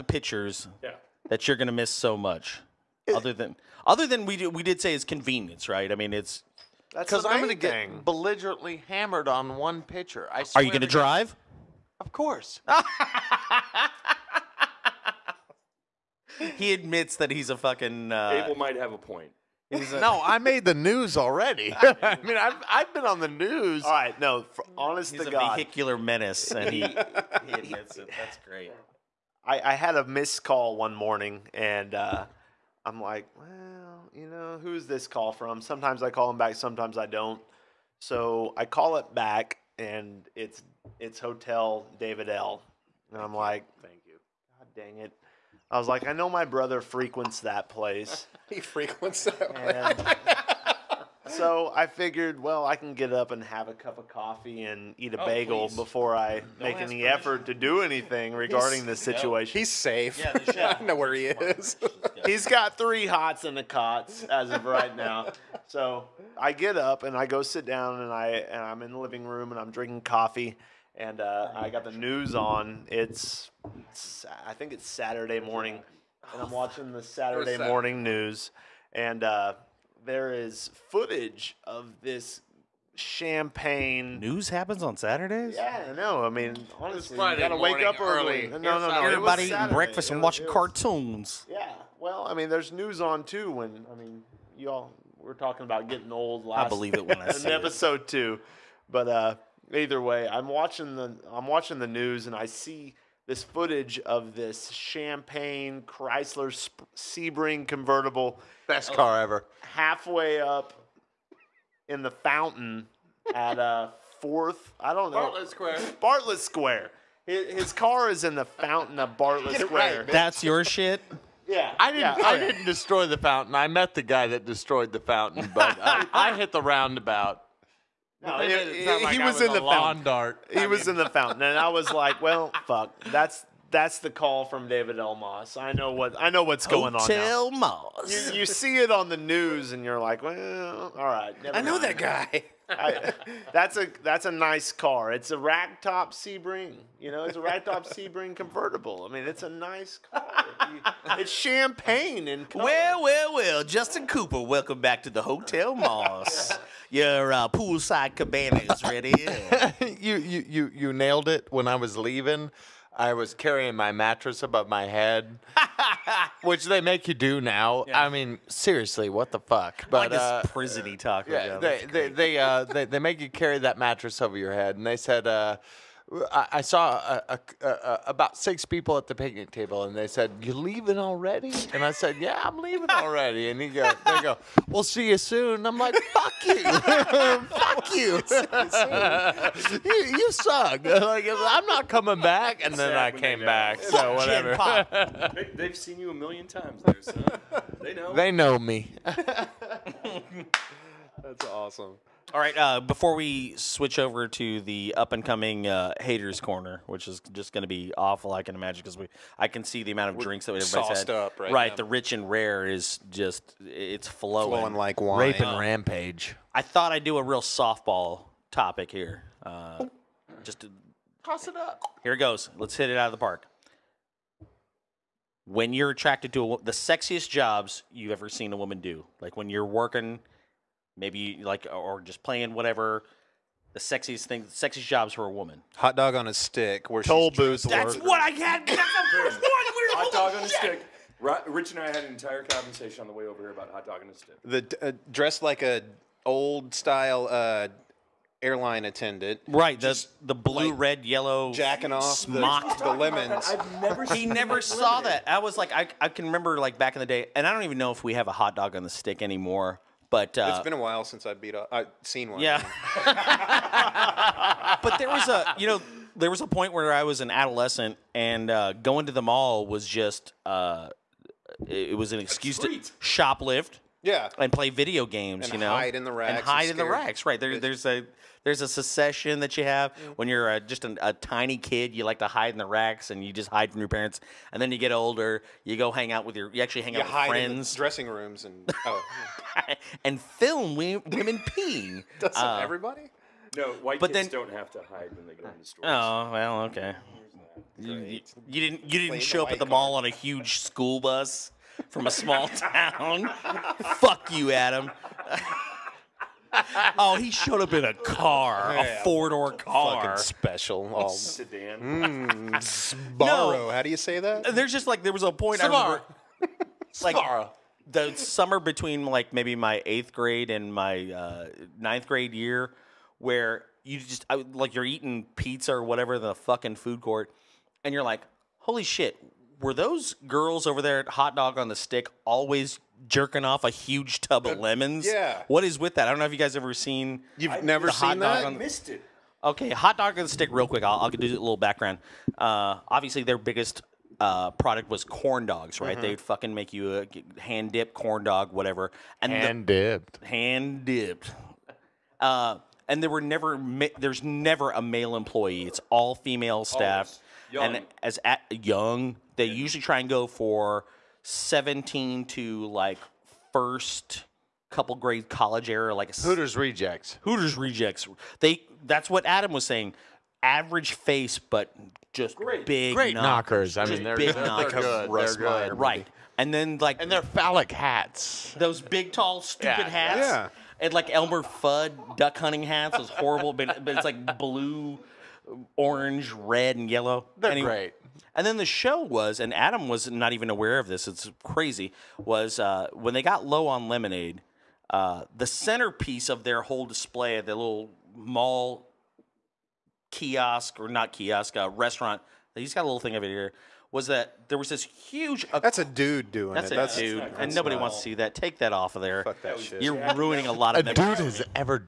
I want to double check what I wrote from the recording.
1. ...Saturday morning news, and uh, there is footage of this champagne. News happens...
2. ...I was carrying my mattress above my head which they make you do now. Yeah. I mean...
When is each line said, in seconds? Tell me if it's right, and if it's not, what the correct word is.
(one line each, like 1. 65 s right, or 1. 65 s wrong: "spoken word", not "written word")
1. 77 s right
2. 162 s right.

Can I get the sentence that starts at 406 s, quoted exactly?
A that's dude, that's and nobody wants to see that.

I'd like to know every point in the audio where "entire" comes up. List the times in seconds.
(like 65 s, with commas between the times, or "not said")
242 s.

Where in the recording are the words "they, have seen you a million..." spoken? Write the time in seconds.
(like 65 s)
195 s.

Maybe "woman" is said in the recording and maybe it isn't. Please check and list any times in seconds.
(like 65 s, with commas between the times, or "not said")
228 s, 235 s.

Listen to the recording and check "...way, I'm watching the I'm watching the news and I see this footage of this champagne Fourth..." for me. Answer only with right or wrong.
wrong.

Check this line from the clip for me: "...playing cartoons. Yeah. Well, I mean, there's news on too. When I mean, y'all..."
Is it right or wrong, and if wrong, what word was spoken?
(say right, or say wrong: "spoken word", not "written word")
wrong: "watching", not "playing".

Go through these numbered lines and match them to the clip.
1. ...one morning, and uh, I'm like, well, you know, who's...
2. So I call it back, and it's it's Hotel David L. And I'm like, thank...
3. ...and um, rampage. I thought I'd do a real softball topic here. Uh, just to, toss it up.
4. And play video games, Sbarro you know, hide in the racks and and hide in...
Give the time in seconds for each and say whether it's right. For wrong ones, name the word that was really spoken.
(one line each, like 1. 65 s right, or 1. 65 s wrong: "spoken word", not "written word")
1. 30 s right
2. 37 s right
3. 215 s right
4. 274 s wrong: "And", not "Sbarro".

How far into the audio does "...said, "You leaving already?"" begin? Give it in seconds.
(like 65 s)
180 s.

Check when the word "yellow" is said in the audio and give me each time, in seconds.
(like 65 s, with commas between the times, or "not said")
251 s, 386 s.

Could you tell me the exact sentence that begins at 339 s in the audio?
Okay, hot dog on the stick, real quick.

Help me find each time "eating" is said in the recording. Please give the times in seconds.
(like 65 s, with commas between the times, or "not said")
89 s, 324 s.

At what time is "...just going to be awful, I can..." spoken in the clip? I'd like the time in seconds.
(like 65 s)
207 s.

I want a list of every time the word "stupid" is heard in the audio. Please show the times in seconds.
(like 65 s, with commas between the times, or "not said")
379 s.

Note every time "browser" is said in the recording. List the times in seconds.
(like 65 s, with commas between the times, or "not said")
not said.